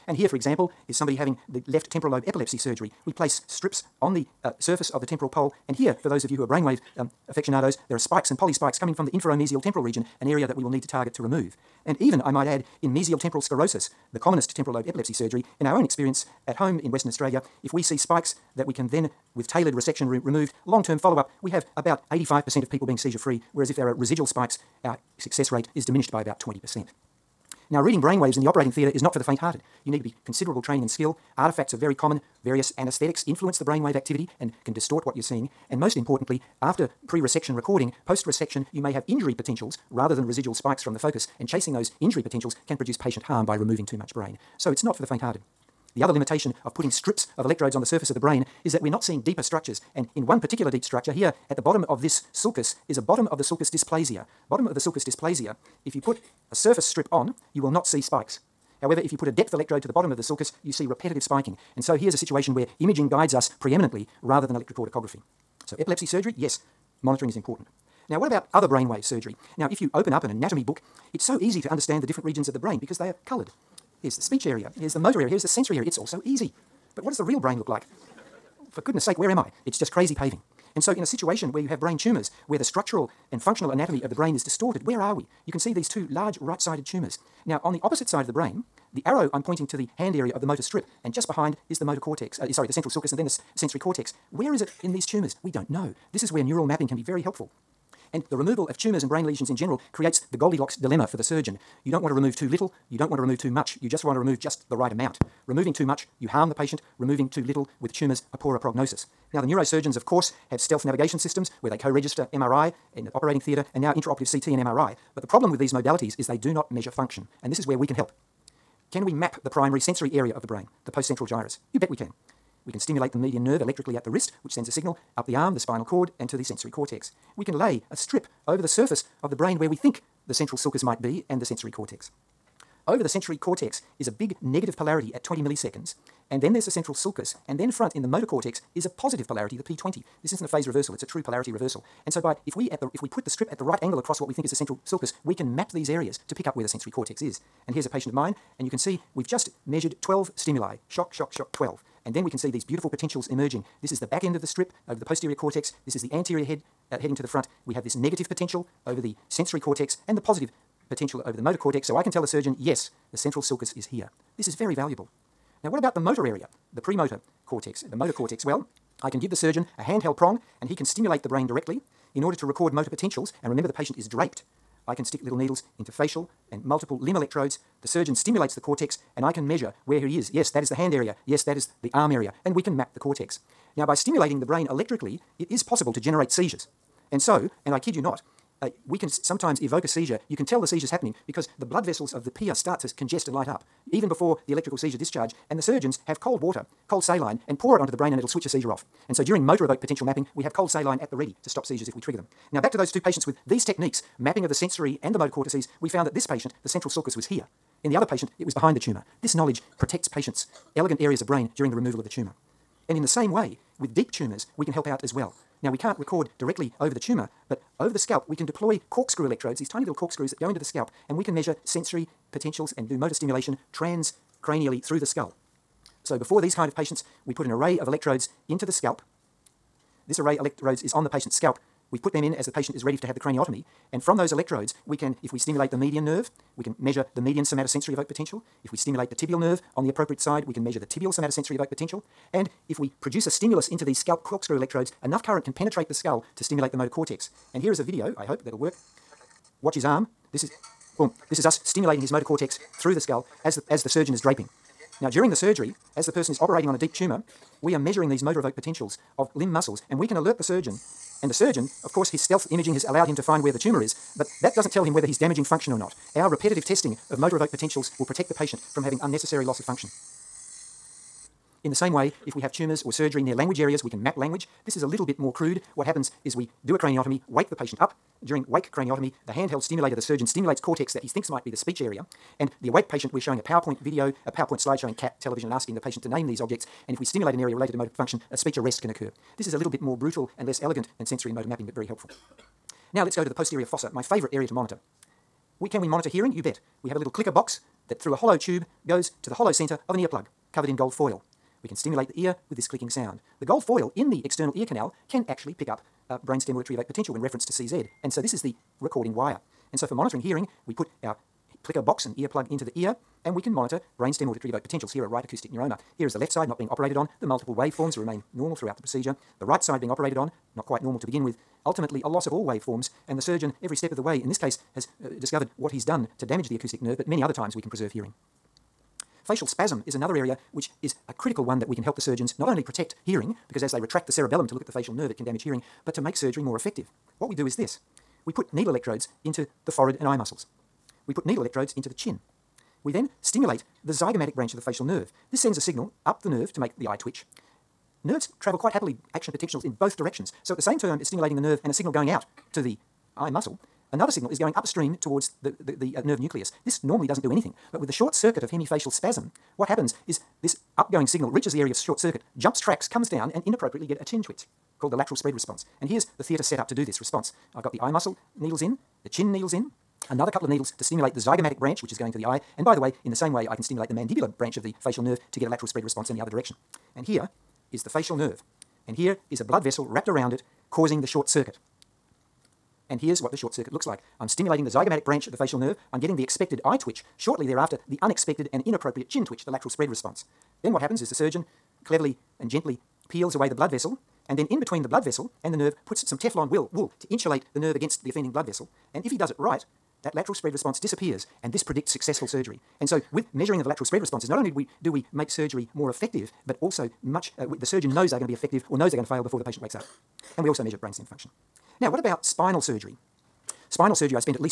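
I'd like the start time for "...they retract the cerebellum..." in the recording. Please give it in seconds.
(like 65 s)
333 s.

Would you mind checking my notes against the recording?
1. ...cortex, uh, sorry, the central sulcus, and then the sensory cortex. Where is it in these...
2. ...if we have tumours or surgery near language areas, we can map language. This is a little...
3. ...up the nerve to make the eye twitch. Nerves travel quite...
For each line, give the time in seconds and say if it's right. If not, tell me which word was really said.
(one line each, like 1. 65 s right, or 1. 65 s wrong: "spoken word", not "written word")
1. 91 s right
2. 272 s right
3. 346 s right.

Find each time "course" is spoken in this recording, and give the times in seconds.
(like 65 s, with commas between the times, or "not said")
110 s, 261 s.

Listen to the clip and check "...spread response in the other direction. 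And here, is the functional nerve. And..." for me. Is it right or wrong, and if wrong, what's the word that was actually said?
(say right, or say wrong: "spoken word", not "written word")
wrong: "facial", not "functional".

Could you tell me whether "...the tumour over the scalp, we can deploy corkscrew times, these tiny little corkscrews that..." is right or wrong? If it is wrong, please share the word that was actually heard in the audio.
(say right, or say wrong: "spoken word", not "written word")
wrong: "electrodes", not "times".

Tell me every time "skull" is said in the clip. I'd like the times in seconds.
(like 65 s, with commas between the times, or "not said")
225 s, 245 s, 252 s.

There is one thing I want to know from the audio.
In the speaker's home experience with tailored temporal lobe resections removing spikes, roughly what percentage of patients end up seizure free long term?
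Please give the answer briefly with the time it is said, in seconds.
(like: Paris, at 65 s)
85%, at 22 s.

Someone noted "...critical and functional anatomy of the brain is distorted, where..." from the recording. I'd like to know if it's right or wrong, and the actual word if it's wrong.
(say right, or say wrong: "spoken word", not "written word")
wrong: "structural", not "critical".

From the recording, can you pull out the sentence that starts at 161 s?
So I can tell a surgeon, yes, the central sulcus is here.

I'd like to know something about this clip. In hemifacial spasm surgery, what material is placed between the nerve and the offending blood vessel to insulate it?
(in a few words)
Teflon wool.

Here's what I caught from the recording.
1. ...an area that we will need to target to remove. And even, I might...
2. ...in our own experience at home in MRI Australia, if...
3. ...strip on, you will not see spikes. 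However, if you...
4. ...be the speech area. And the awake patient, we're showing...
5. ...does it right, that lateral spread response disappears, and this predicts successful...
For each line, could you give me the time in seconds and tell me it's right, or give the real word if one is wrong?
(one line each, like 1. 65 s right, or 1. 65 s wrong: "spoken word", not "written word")
1. 10 s right
2. 15 s wrong: "Western", not "MRI"
3. 56 s right
4. 281 s right
5. 399 s right.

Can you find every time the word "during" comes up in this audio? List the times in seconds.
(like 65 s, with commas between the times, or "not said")
199 s, 211 s, 255 s, 278 s.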